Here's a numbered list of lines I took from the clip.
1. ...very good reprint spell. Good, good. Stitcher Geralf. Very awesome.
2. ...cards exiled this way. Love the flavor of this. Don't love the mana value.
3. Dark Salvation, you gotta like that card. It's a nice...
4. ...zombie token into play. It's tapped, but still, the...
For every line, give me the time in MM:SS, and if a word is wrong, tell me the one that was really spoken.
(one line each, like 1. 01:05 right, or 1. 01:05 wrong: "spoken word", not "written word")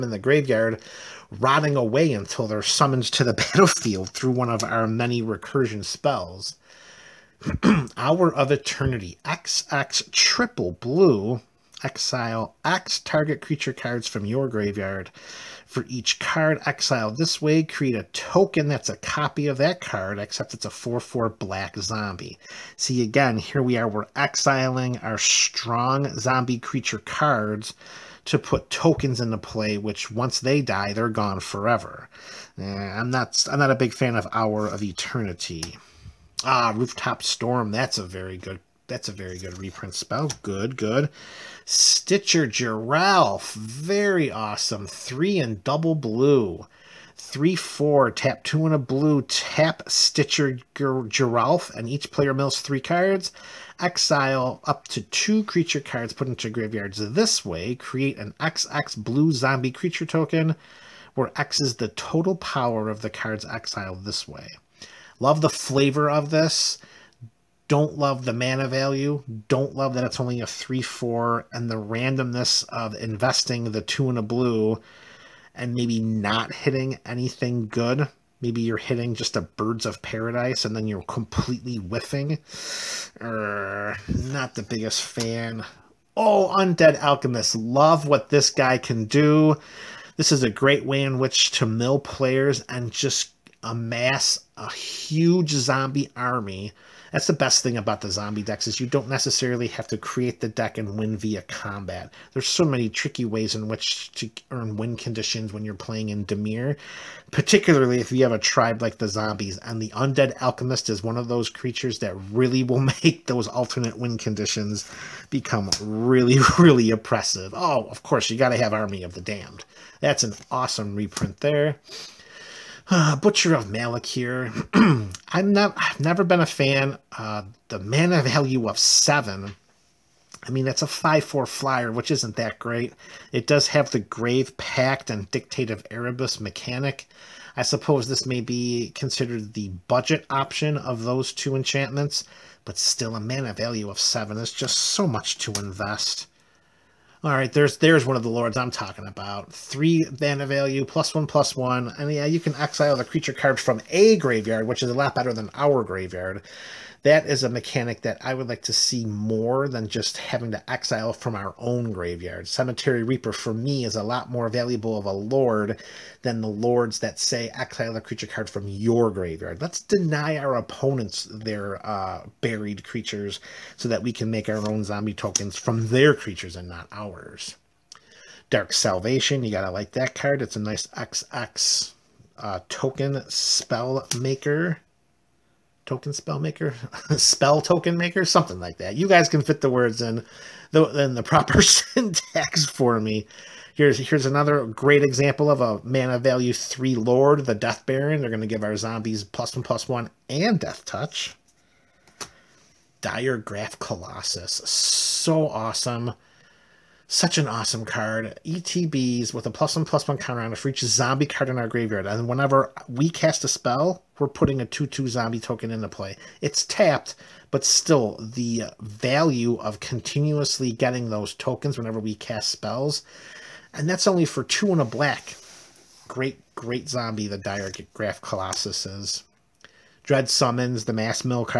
1. 00:39 right
2. 01:03 right
3. 02:58 right
4. 03:35 right.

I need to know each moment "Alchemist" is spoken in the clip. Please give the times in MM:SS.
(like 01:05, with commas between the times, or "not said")
01:26, 01:50.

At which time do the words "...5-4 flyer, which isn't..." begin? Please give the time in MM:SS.
02:10.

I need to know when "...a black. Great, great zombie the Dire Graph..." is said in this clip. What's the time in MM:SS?
03:44.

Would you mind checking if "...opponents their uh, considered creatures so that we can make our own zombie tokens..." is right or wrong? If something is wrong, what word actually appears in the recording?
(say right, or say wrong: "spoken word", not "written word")
wrong: "buried", not "considered".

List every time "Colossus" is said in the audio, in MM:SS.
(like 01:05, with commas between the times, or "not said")
03:23, 03:48.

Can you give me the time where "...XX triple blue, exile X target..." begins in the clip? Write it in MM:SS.
00:09.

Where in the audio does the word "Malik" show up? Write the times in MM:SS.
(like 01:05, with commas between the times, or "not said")
02:03.